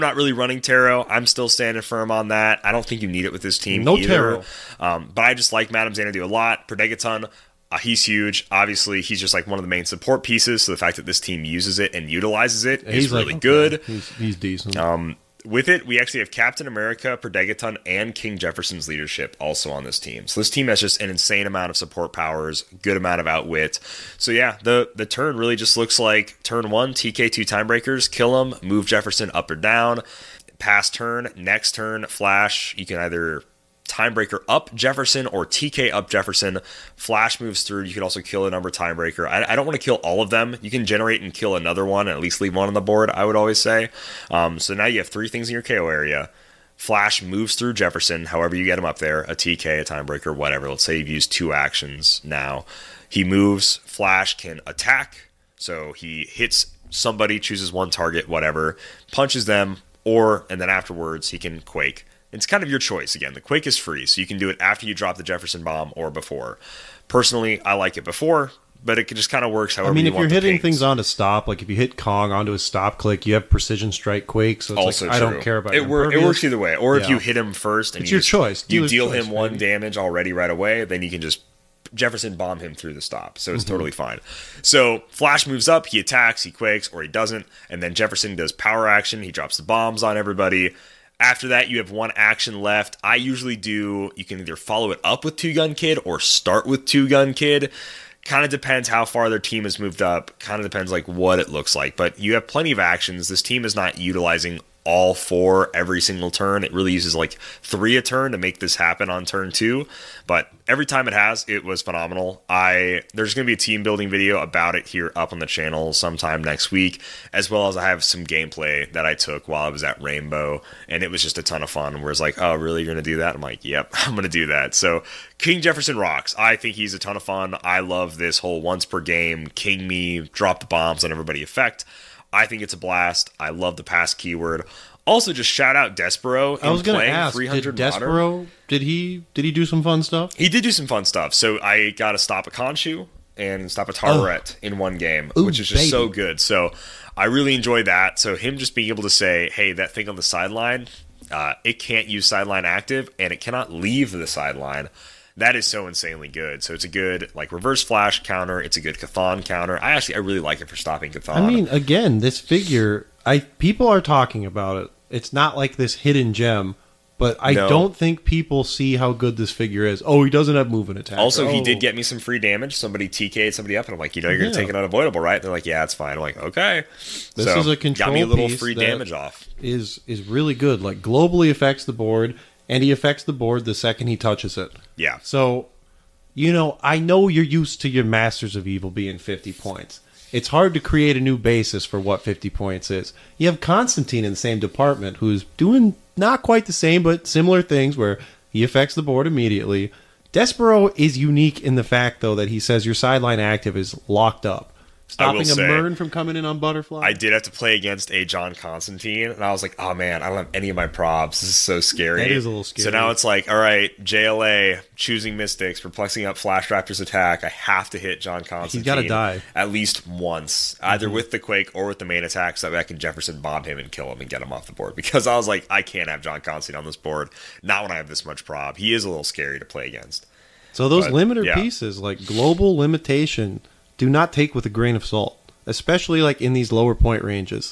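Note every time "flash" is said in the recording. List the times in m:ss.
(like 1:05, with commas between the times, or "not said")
0:32, 0:36, 0:46, 0:53, 1:25, 2:37, 3:36.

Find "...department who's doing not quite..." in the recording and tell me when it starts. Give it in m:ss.
3:14.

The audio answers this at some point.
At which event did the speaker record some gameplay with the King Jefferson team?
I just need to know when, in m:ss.
2:00.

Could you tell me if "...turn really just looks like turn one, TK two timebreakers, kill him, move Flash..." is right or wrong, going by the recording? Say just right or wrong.
wrong.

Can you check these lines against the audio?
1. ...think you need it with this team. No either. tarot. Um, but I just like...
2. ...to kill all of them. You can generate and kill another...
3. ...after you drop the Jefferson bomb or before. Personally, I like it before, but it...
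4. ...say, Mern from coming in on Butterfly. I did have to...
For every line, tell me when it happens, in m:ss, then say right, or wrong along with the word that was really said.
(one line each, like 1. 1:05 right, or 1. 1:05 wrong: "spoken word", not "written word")
1. 0:02 right
2. 0:39 right
3. 1:04 right
4. 3:25 right.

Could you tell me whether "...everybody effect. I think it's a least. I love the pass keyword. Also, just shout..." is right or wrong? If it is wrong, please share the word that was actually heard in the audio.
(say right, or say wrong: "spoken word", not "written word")
wrong: "blast", not "least".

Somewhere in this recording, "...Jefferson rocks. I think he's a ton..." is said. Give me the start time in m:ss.
2:05.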